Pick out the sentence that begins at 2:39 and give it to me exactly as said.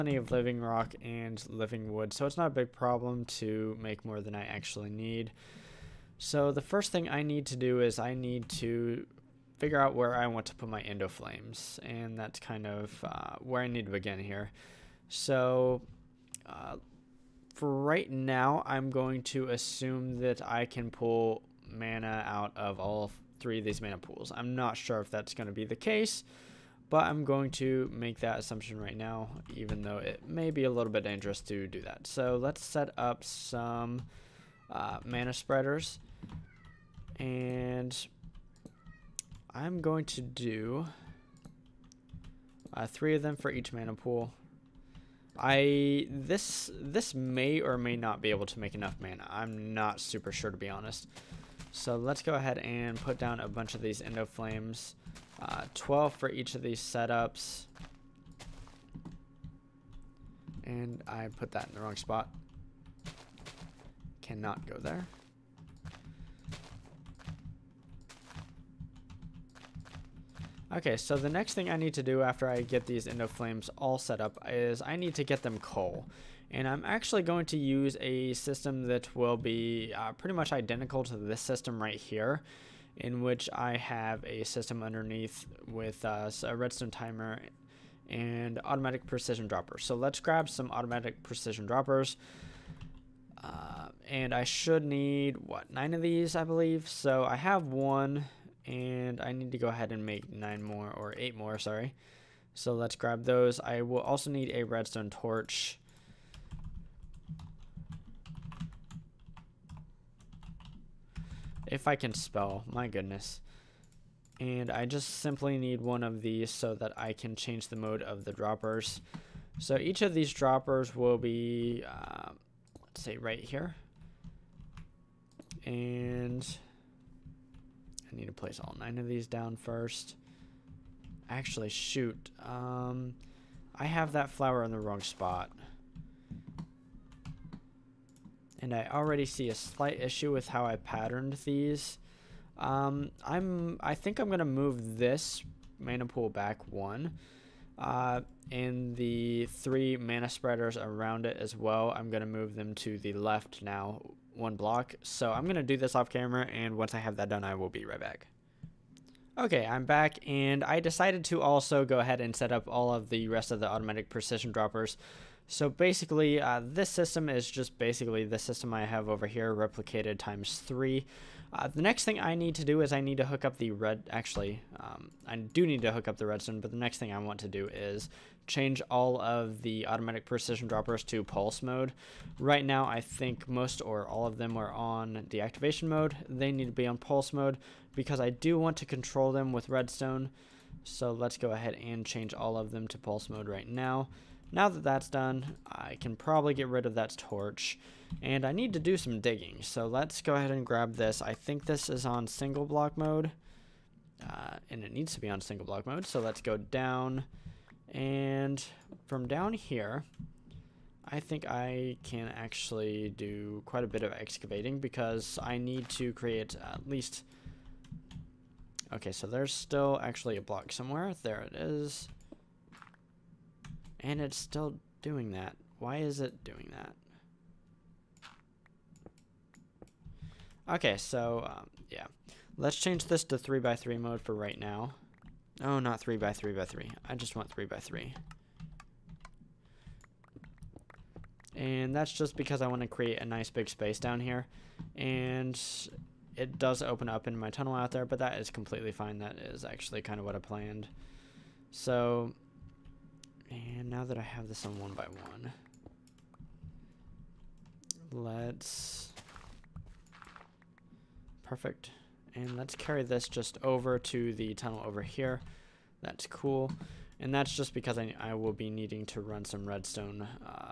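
Okay, I'm back, and I decided to also go ahead and set up all of the rest of the automatic precision droppers.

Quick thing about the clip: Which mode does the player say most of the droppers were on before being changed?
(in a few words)
deactivation mode.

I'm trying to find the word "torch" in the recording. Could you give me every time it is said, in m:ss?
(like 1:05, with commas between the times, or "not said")
1:45, 3:17.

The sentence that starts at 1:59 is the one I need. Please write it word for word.
So each of these droppers will be, uh, let's say right here.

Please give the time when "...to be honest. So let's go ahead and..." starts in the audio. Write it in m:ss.
0:50.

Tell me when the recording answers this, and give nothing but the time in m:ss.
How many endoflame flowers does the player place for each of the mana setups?
0:55.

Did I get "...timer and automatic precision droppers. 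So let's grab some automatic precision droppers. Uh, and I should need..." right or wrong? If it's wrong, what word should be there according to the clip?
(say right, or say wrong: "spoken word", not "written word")
right.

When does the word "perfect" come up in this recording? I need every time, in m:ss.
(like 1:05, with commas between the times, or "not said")
4:21.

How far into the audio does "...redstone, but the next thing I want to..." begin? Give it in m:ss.
2:56.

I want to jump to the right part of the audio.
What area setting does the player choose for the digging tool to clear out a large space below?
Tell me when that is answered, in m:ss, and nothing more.
3:53.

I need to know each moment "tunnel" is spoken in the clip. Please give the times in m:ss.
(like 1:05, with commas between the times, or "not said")
4:07, 4:24.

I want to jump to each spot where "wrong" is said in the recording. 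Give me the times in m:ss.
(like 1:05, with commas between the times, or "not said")
1:01, 2:14.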